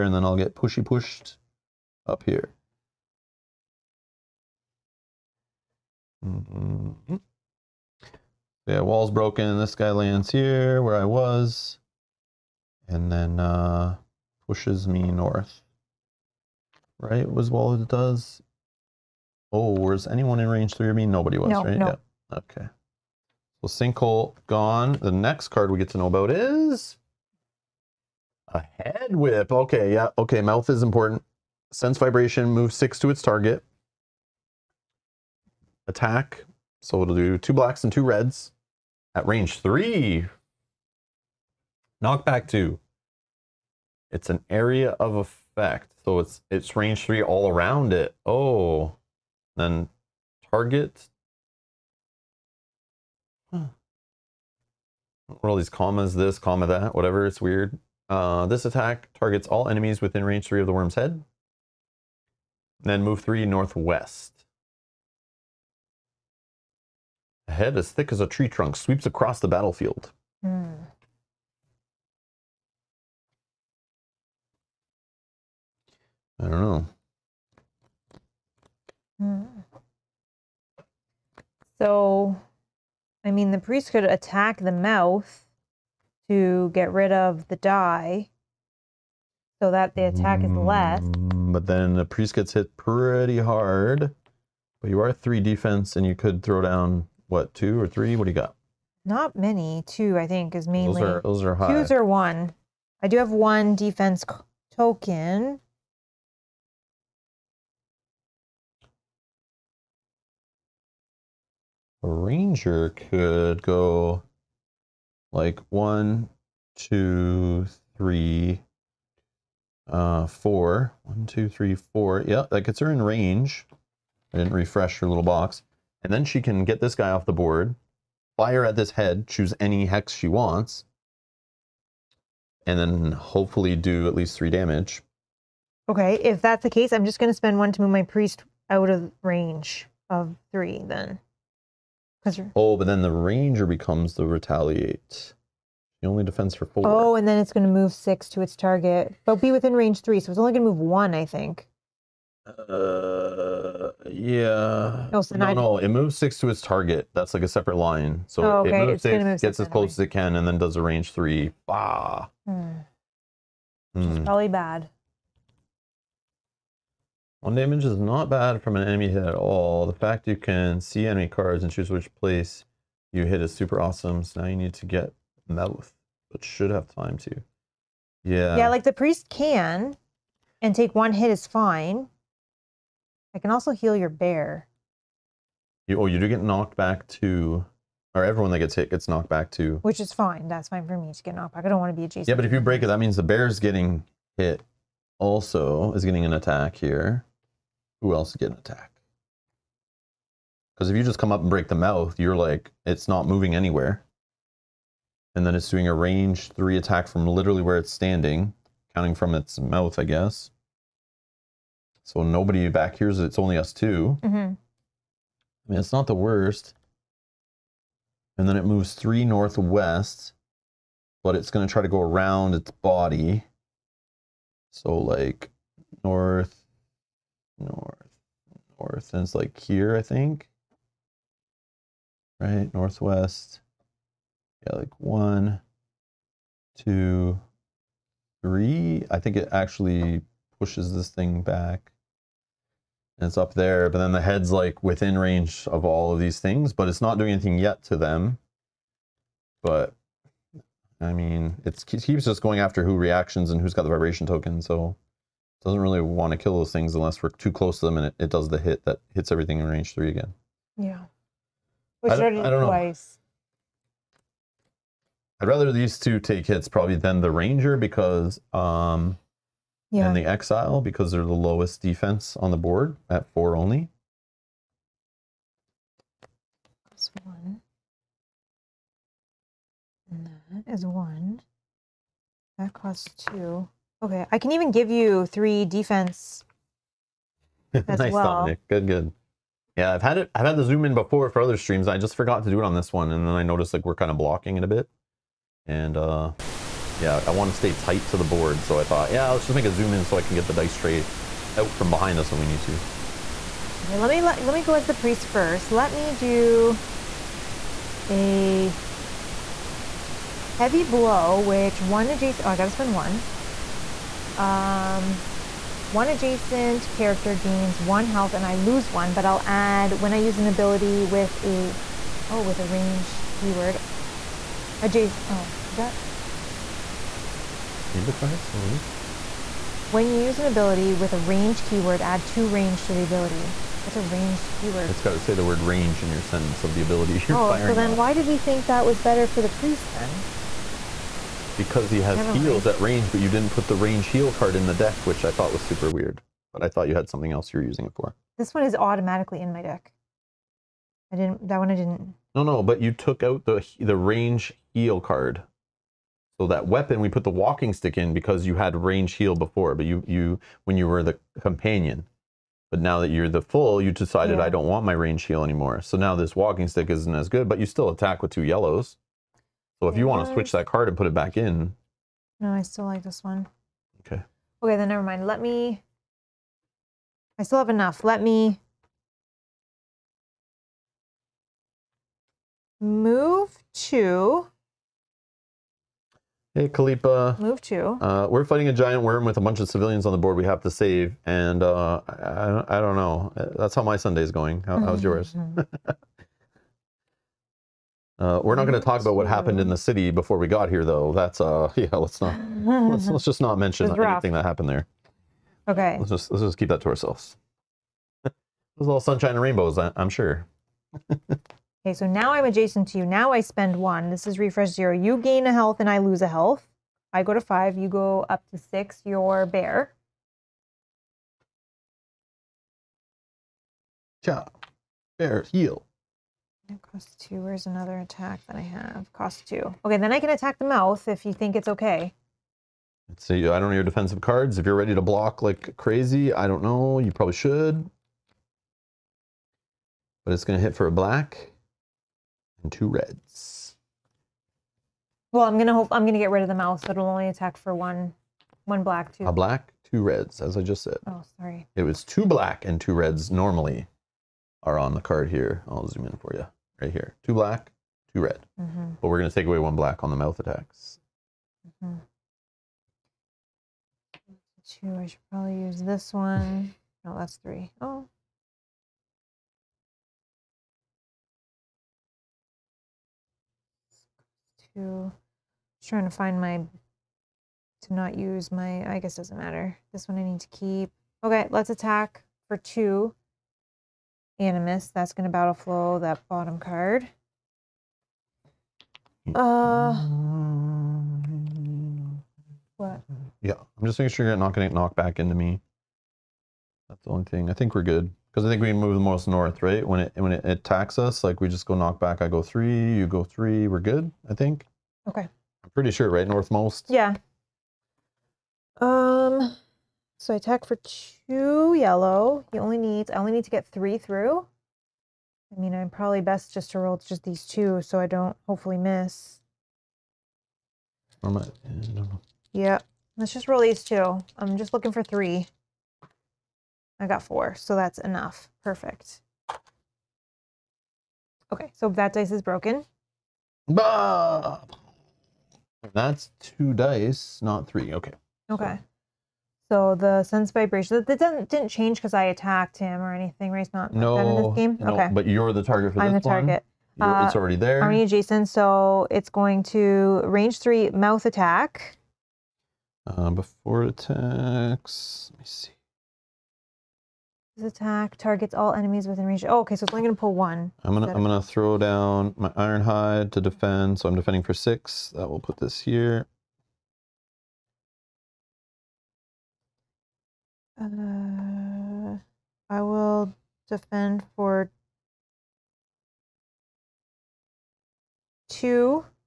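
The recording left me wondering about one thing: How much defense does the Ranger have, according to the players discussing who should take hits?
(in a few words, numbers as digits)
4.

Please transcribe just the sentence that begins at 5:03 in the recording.
Okay, let me let, let me go as the priest first.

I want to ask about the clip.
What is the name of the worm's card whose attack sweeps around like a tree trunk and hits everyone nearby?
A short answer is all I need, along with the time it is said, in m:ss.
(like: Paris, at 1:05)
Head whip, at 0:28.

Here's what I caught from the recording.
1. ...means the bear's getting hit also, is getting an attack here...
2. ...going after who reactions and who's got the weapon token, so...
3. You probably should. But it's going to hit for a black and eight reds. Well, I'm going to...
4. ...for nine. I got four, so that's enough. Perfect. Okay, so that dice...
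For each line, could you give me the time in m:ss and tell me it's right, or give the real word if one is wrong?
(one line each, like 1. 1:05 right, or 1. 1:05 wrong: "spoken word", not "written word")
1. 3:12 right
2. 4:12 wrong: "vibration", not "weapon"
3. 7:17 wrong: "two", not "eight"
4. 8:44 wrong: "three", not "nine".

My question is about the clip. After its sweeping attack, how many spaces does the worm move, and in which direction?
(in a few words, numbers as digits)
3 northwest.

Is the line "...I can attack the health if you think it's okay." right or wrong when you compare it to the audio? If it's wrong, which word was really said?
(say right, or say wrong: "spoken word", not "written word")
wrong: "mouth", not "health".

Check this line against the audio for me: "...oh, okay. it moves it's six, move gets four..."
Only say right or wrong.
wrong.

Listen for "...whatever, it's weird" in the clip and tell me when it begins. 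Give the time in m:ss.
0:56.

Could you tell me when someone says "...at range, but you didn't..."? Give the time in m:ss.
5:42.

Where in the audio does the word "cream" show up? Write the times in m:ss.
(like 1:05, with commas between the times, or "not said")
not said.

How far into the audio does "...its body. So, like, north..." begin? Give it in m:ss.
3:42.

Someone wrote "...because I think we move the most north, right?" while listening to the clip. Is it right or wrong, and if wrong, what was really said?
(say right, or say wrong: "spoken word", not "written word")
right.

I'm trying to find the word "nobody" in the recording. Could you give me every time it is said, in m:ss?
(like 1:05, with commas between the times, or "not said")
0:21, 3:32.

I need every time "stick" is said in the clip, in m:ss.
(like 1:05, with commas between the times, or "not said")
5:57, 6:06.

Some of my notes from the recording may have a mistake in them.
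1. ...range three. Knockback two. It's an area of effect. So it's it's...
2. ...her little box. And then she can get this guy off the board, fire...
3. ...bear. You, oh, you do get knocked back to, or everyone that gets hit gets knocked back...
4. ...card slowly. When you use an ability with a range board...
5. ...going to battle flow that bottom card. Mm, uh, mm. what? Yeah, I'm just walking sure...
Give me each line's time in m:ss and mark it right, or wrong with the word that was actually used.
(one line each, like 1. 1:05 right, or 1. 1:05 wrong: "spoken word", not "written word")
1. 0:39 right
2. 2:04 right
3. 3:04 right
4. 5:28 wrong: "keyword", not "board"
5. 8:05 wrong: "making", not "walking".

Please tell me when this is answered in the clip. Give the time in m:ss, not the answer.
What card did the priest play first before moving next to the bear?
5:10.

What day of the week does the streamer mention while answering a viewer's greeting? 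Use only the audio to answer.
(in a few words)
Sunday.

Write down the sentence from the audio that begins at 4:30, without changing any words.
and the Exile because they're the lowest defense on the board at four only.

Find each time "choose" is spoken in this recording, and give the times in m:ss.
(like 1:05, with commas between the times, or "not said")
2:09, 2:51.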